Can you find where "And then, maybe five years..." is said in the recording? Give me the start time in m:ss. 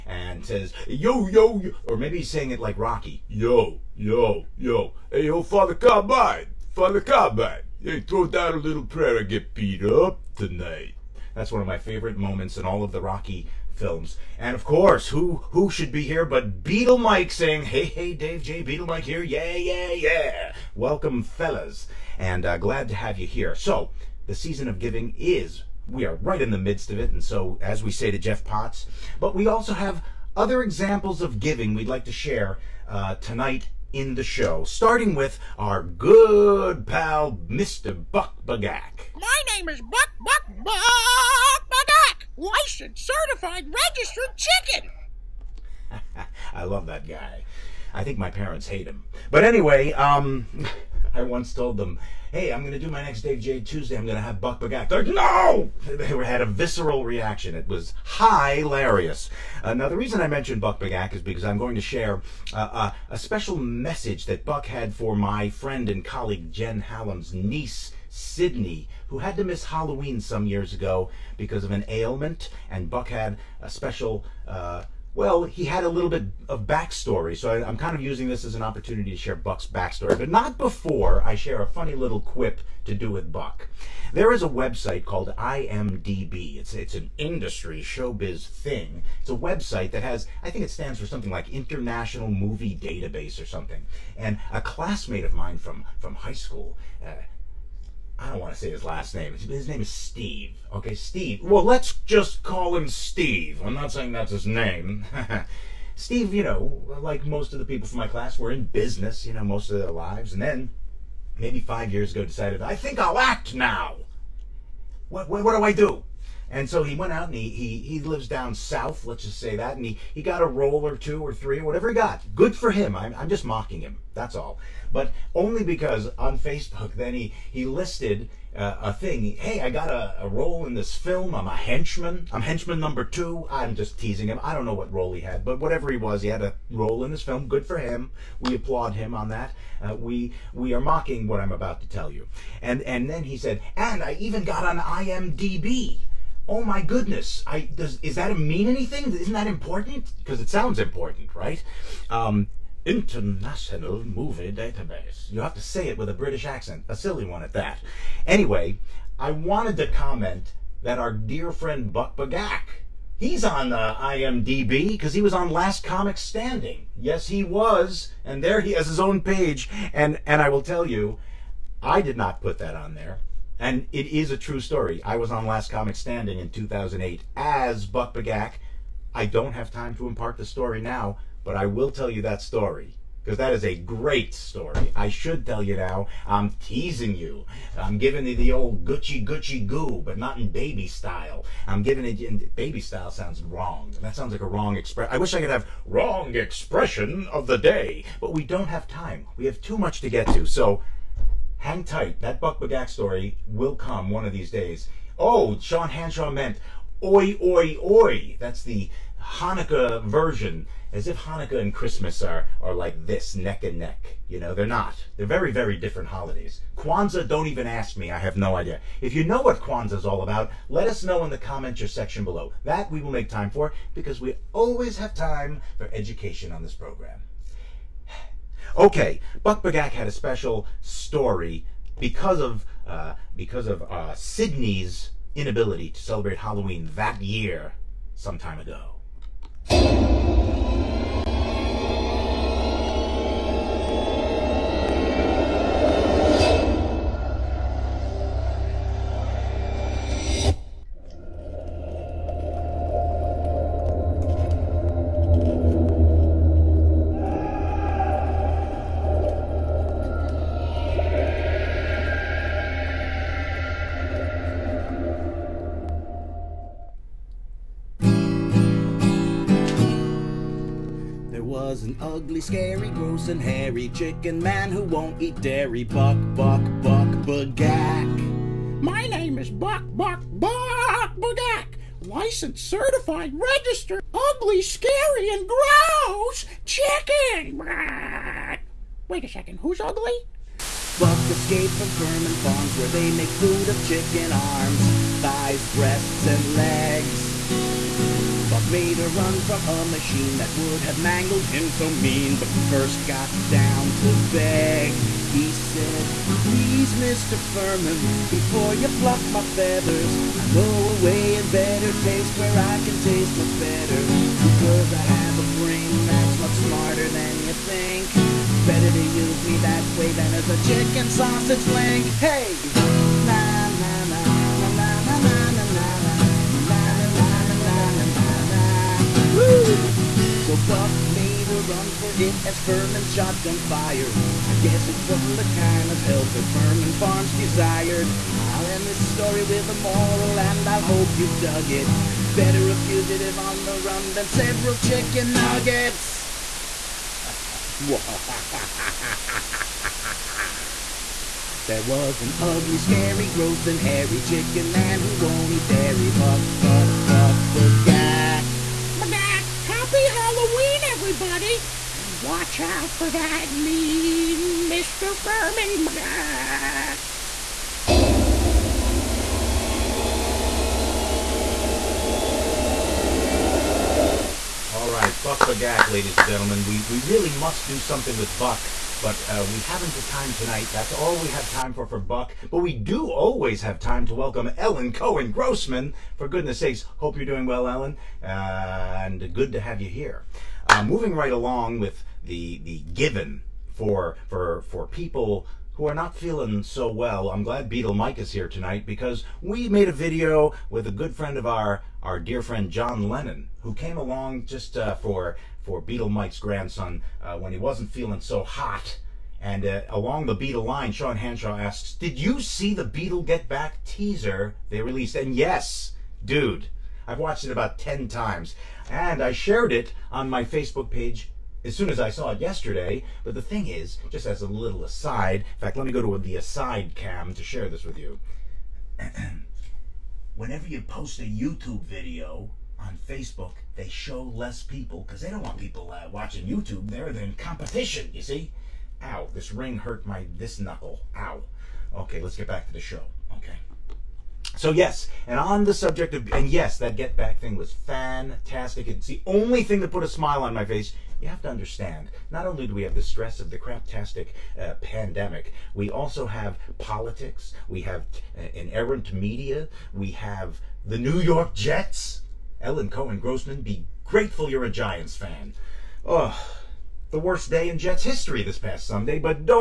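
1:50.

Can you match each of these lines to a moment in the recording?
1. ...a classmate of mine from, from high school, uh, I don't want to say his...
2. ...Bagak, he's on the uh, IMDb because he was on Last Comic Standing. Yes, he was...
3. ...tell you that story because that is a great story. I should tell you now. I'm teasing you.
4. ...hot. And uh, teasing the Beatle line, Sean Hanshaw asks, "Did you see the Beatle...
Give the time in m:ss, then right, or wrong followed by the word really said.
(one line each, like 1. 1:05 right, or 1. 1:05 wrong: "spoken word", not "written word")
1. 1:34 right
2. 2:42 right
3. 3:01 right
4. 6:48 wrong: "along", not "teasing".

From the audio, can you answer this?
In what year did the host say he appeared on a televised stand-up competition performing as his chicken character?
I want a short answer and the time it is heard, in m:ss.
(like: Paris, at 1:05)
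2008, at 2:56.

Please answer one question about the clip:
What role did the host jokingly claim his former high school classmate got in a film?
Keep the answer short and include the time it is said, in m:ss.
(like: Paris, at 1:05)
Henchman number two, at 2:12.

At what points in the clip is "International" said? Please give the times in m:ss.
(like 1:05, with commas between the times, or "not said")
1:31, 2:32.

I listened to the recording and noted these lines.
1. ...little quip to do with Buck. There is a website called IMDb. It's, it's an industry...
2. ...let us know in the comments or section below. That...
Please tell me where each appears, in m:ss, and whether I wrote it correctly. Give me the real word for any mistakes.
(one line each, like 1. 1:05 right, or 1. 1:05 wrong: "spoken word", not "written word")
1. 1:21 right
2. 3:40 right.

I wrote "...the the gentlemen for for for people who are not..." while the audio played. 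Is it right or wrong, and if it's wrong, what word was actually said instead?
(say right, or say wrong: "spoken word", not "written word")
wrong: "given", not "gentlemen".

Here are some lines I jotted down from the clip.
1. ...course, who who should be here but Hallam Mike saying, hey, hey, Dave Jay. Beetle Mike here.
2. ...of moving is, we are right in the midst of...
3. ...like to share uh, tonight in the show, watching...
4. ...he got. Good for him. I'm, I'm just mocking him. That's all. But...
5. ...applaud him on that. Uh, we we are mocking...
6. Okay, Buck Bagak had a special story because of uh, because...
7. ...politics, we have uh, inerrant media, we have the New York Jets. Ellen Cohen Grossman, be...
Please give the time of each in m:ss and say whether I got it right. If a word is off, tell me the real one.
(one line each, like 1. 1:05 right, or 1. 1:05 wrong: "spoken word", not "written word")
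1. 0:14 wrong: "Beetle", not "Hallam"
2. 0:24 wrong: "giving", not "moving"
3. 0:31 wrong: "starting", not "watching"
4. 2:01 right
5. 2:18 right
6. 3:48 right
7. 7:36 right.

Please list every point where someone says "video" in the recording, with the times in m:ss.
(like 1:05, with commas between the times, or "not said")
6:39, 7:11.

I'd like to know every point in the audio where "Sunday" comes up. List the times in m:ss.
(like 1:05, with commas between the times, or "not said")
7:48.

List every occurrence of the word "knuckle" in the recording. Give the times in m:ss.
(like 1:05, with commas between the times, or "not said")
7:20.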